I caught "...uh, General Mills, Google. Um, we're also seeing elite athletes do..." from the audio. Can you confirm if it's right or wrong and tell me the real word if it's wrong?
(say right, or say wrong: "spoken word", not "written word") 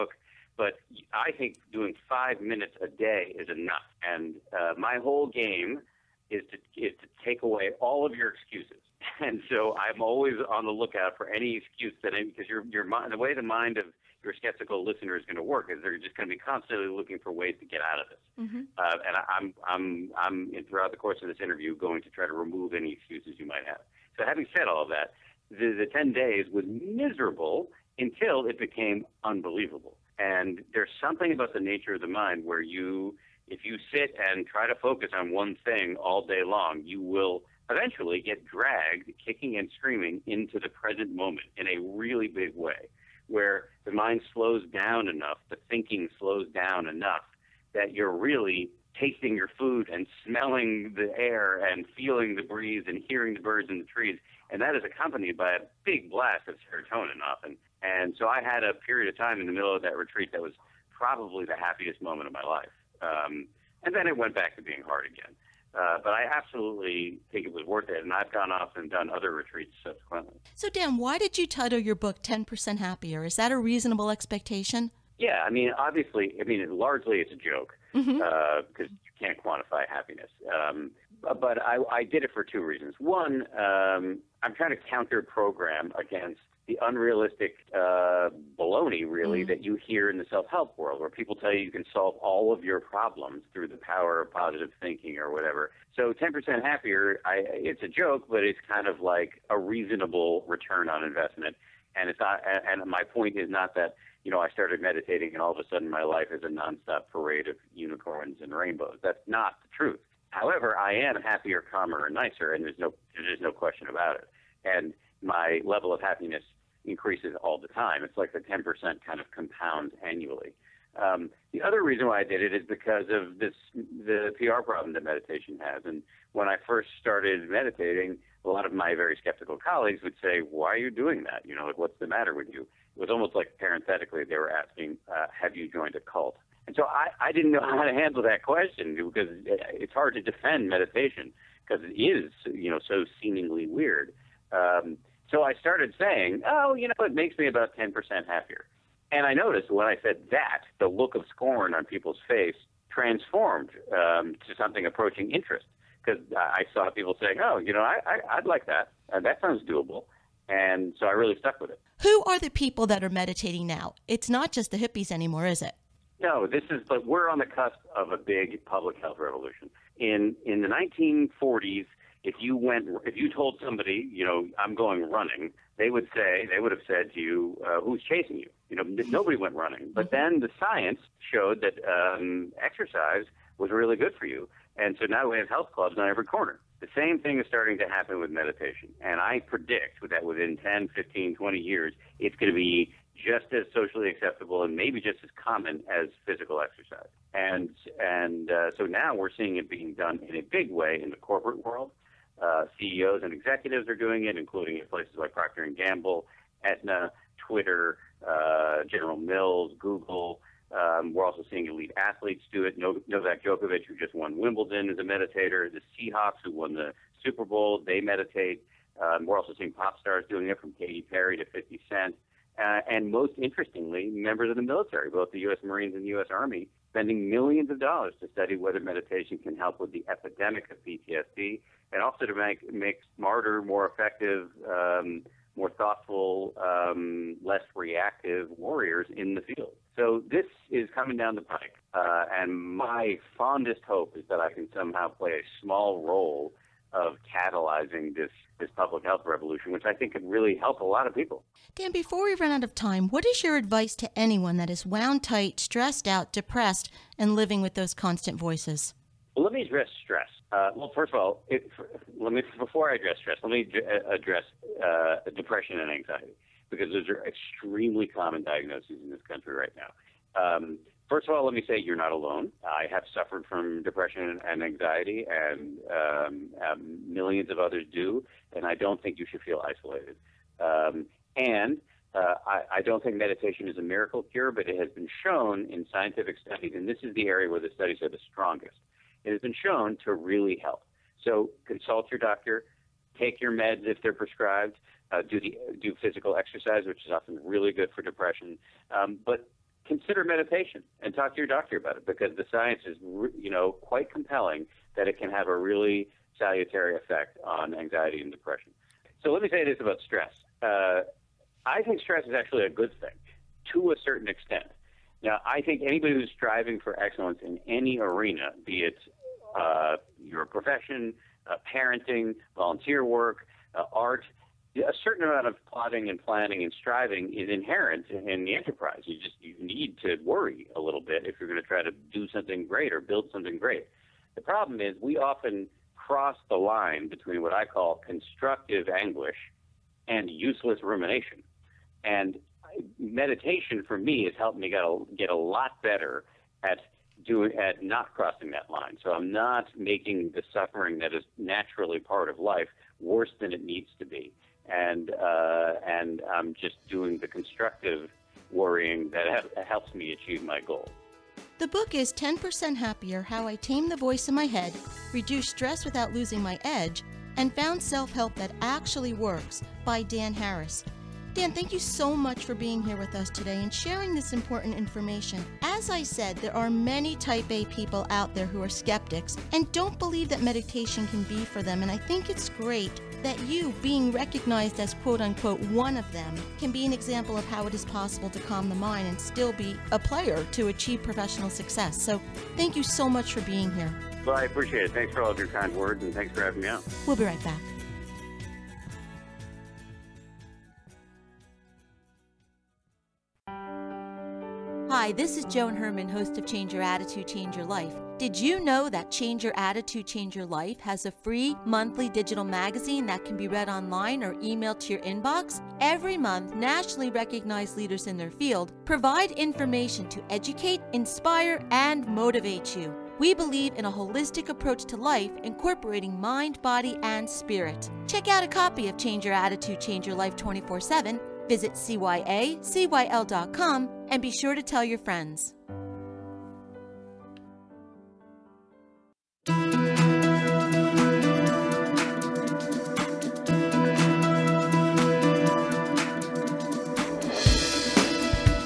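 right.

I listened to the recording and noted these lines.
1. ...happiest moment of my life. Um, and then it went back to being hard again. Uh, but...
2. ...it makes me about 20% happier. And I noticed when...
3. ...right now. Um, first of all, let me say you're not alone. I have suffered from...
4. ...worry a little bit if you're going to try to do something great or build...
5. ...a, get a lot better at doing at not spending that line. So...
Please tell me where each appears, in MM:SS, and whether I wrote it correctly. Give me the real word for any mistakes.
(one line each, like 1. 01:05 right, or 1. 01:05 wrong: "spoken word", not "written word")
1. 01:01 right
2. 02:27 wrong: "10", not "20"
3. 04:29 right
4. 05:30 right
5. 05:44 wrong: "crossing", not "spending".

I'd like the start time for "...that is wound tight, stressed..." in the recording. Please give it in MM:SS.
04:14.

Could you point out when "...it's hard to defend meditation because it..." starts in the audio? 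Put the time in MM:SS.
02:19.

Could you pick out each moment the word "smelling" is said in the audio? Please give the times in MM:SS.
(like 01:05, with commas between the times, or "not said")
00:50.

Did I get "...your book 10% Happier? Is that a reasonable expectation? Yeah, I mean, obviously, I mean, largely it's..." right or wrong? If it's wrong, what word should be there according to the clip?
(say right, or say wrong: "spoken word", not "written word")
right.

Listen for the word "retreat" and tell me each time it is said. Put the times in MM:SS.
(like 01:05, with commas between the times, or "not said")
00:59, 01:09.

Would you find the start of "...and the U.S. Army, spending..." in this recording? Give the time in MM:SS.
03:45.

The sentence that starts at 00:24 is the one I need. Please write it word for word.
So having said all of that, the, the 10 days was miserable until it became unbelievable.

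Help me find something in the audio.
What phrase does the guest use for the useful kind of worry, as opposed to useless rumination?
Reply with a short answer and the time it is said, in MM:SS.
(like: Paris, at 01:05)
constructive anguish, at 05:38.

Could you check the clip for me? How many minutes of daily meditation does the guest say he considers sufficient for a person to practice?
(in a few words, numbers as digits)
5.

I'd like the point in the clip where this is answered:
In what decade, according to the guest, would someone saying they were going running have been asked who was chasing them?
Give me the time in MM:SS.
02:50.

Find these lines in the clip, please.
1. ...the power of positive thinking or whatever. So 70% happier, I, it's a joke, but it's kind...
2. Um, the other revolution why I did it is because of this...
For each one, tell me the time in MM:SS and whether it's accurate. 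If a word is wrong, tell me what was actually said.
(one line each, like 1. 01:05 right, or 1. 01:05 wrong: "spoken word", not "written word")
1. 01:33 wrong: "10", not "70"
2. 02:01 wrong: "reason", not "revolution".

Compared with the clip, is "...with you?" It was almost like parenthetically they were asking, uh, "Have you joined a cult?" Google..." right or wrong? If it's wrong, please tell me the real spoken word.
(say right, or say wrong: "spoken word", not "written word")
wrong: "And", not "Google".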